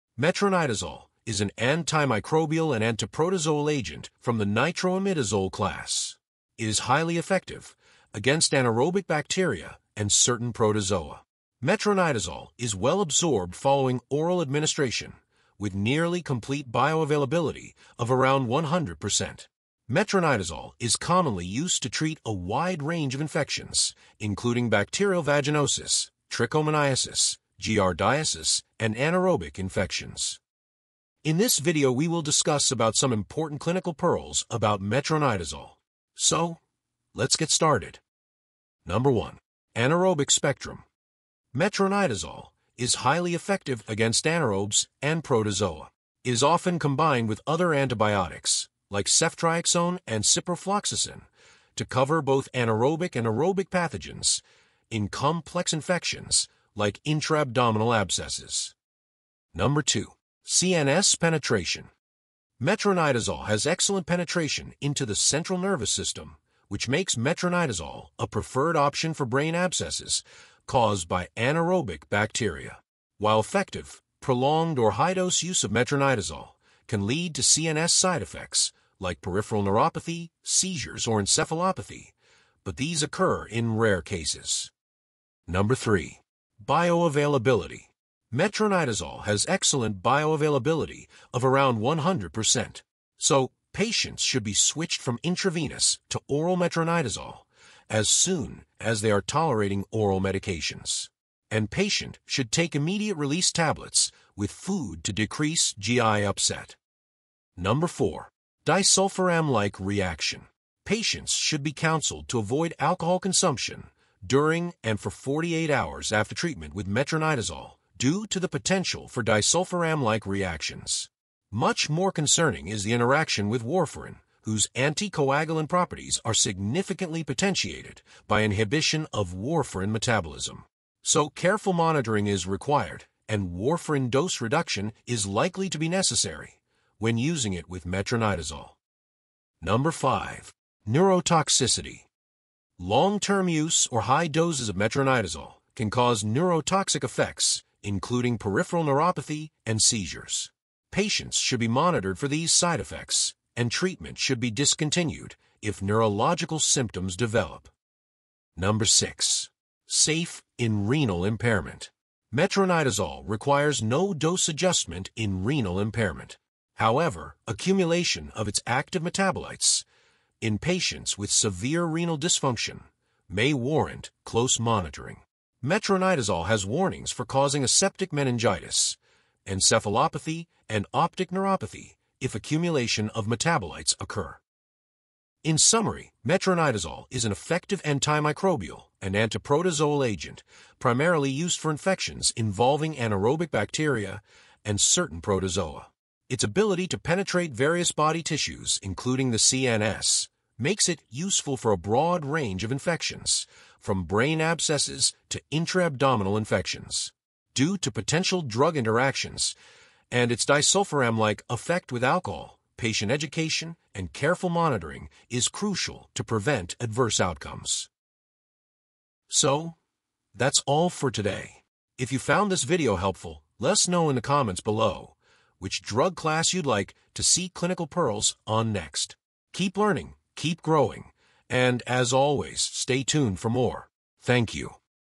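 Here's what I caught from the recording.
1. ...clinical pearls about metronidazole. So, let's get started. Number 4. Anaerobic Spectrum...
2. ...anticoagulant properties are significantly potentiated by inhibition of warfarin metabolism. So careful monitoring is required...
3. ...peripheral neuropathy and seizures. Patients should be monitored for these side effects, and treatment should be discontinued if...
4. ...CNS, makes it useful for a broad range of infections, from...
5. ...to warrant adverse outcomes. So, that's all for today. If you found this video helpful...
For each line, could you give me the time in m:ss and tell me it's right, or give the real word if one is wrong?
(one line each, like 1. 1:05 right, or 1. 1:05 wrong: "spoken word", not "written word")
1. 0:33 wrong: "1", not "4"
2. 2:04 right
3. 2:28 right
4. 3:19 right
5. 3:36 wrong: "prevent", not "warrant".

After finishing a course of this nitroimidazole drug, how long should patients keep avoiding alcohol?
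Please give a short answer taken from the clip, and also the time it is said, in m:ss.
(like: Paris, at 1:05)
48 hours, at 1:55.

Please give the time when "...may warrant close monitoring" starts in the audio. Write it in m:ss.
2:53.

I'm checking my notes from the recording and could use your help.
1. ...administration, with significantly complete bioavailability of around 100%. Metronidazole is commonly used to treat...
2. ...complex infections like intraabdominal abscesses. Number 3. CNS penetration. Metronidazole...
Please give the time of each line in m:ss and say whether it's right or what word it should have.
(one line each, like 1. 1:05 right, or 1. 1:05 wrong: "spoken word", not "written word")
1. 0:14 wrong: "nearly", not "significantly"
2. 0:55 wrong: "2", not "3".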